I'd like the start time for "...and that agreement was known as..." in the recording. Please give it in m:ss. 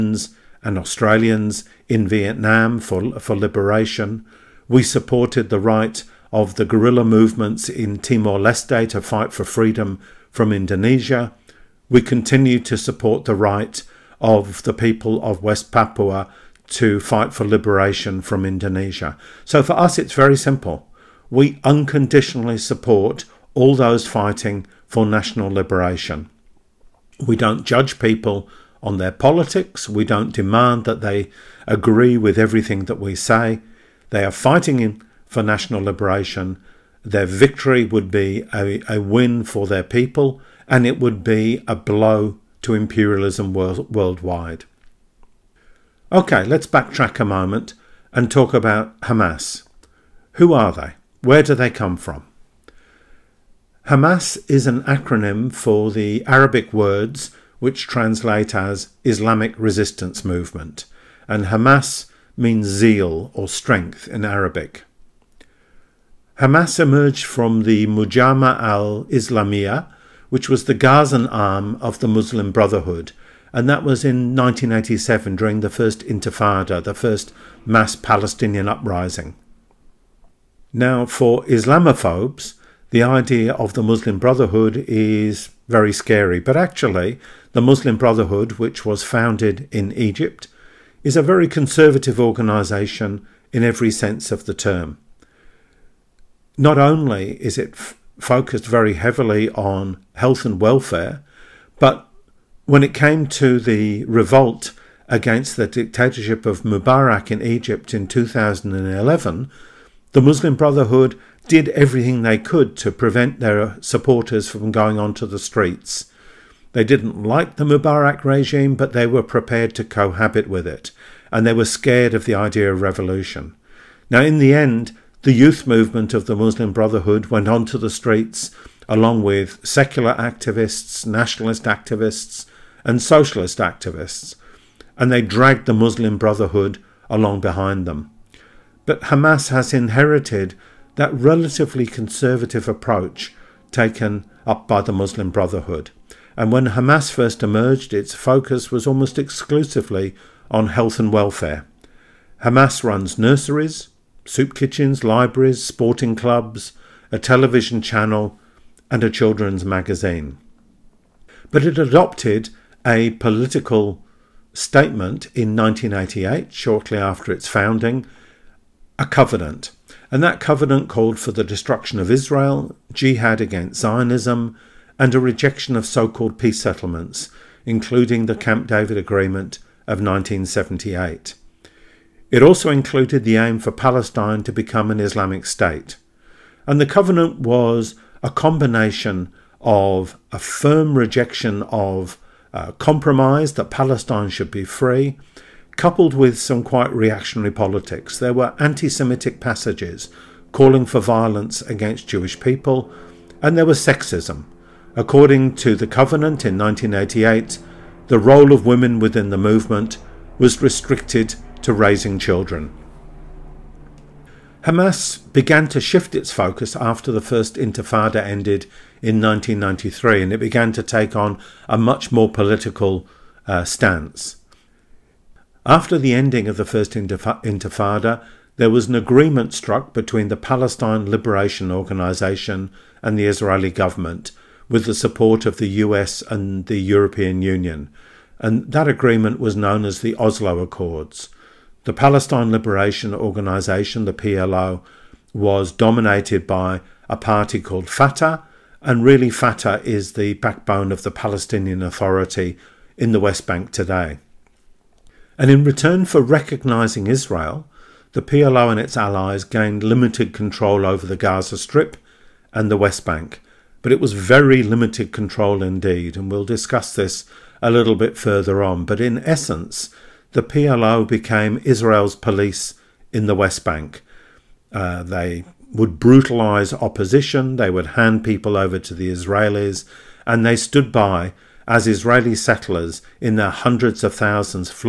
3:58.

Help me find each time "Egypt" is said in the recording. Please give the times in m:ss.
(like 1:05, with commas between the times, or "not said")
1:29, 1:47.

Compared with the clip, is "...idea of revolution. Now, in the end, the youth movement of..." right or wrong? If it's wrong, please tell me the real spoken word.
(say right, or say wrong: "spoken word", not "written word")
right.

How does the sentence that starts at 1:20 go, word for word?
Now, for Islamophobes, the idea of the Muslim Brotherhood is very scary.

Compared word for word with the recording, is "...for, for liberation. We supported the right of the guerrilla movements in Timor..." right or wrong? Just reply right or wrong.
right.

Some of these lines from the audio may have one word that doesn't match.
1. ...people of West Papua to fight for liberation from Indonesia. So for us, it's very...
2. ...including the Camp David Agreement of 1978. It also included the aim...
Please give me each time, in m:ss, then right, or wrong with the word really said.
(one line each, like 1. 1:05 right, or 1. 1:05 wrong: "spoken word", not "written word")
1. 0:14 right
2. 2:57 right.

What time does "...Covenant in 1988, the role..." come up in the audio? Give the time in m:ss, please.
3:25.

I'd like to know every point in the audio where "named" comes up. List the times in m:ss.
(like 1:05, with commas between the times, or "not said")
not said.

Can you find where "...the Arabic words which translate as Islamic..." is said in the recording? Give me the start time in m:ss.
0:55.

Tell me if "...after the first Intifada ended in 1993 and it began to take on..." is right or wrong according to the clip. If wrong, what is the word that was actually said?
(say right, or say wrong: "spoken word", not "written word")
right.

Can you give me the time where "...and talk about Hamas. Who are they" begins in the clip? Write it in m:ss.
0:48.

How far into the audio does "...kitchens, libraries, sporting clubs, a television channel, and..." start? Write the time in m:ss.
2:34.